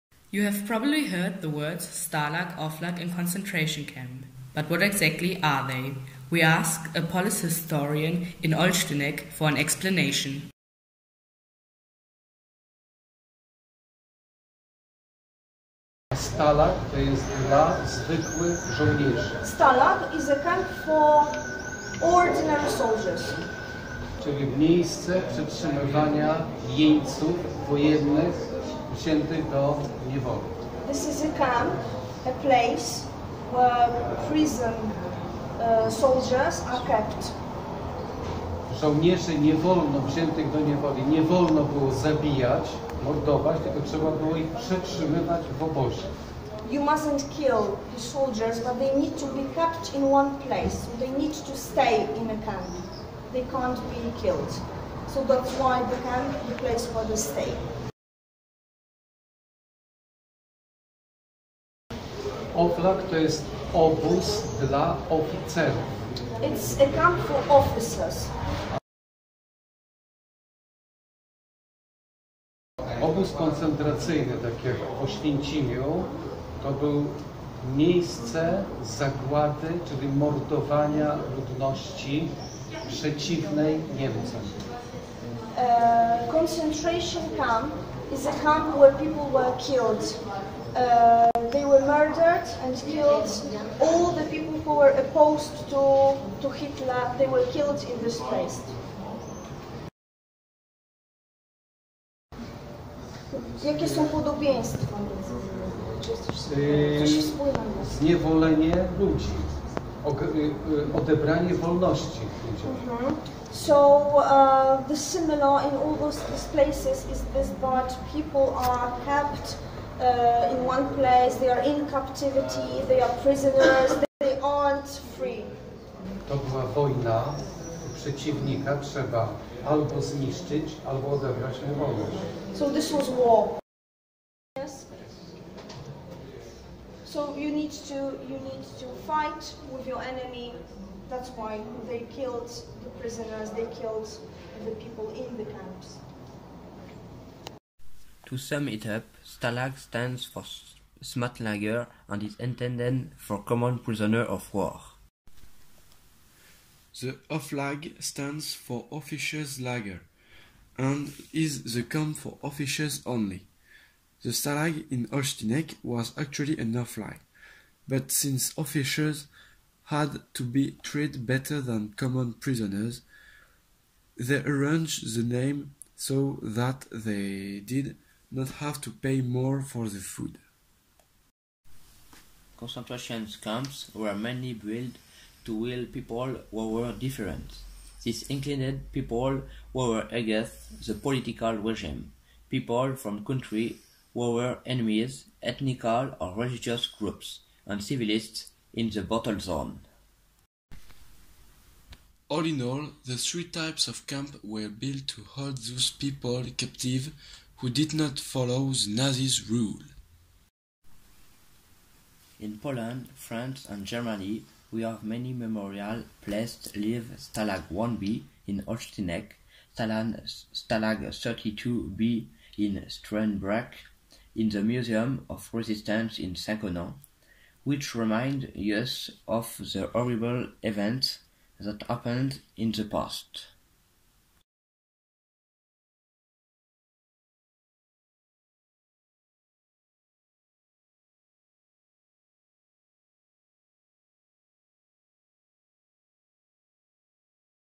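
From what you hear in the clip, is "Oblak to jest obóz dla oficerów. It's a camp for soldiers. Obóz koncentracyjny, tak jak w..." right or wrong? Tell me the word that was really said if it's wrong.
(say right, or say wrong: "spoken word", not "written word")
wrong: "officers", not "soldiers".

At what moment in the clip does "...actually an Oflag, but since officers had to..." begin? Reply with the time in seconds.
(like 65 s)
166 s.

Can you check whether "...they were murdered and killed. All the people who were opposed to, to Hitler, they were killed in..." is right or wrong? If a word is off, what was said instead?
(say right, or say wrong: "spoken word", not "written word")
right.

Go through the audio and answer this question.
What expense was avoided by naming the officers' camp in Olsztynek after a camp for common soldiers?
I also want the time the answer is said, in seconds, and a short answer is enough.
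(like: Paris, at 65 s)
Food, at 179 s.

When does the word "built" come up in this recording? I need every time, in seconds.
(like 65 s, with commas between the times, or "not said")
184 s, 204 s.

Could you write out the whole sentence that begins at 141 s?
That's why they killed the prisoners, they killed the people in the camps.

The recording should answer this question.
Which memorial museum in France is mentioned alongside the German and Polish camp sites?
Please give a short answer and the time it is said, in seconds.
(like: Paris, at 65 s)
Museum of Resistance in Saint-Connan, at 224 s.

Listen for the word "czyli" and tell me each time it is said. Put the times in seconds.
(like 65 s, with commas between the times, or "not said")
24 s, 79 s.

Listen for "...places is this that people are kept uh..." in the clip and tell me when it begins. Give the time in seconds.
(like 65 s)
116 s.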